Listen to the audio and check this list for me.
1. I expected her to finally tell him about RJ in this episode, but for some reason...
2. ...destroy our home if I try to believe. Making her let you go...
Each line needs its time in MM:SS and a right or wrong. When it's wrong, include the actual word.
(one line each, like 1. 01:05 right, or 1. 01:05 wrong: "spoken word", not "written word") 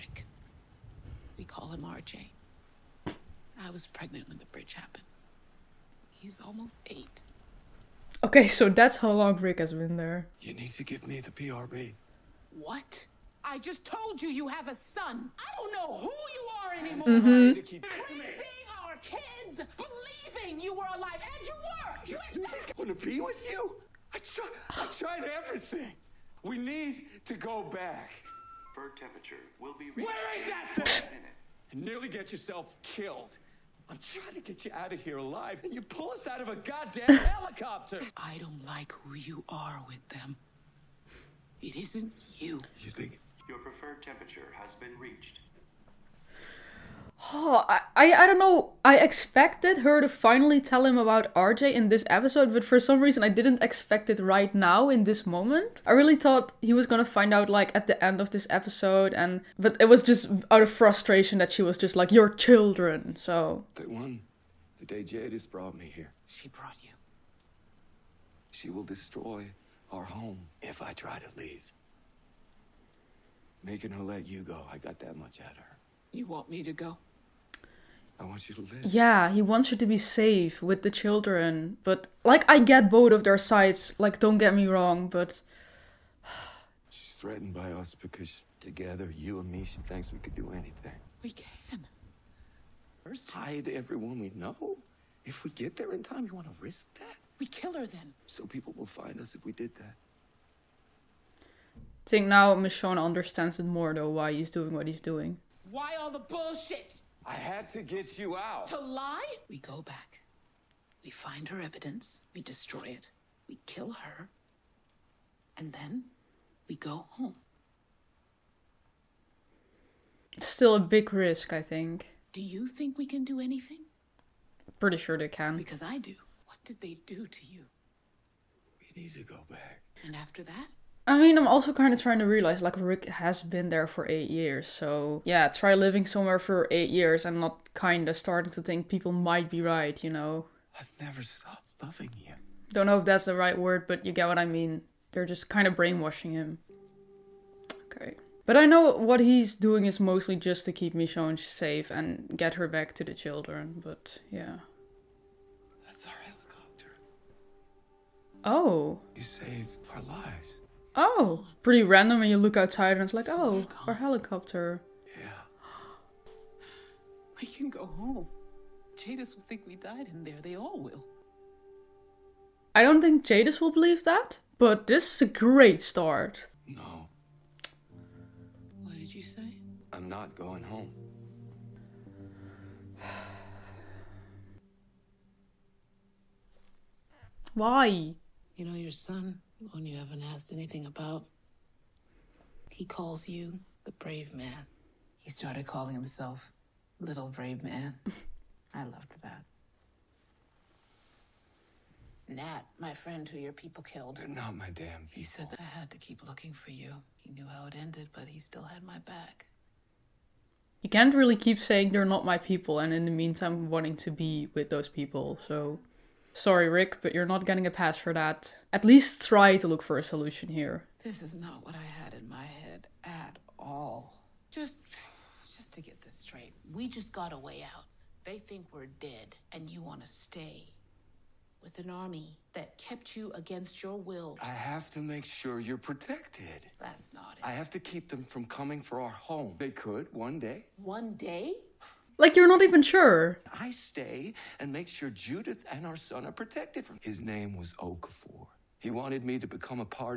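1. 00:48 right
2. 01:08 wrong: "leave", not "believe".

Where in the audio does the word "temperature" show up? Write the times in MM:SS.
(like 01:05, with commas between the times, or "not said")
00:28, 00:44.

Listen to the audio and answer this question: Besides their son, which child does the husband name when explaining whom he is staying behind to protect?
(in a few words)
Judith.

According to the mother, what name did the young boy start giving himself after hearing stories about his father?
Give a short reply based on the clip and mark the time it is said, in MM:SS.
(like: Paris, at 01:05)
Little Brave Man, at 03:16.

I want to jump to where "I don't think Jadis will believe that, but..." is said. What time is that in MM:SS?
02:52.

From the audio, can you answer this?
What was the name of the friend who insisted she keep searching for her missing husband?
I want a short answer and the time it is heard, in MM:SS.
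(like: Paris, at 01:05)
Okafor, at 04:07.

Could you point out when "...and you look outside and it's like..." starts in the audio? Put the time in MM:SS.
02:42.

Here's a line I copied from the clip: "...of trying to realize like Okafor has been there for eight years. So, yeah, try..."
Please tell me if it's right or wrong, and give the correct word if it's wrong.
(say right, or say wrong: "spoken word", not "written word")
wrong: "Rick", not "Okafor".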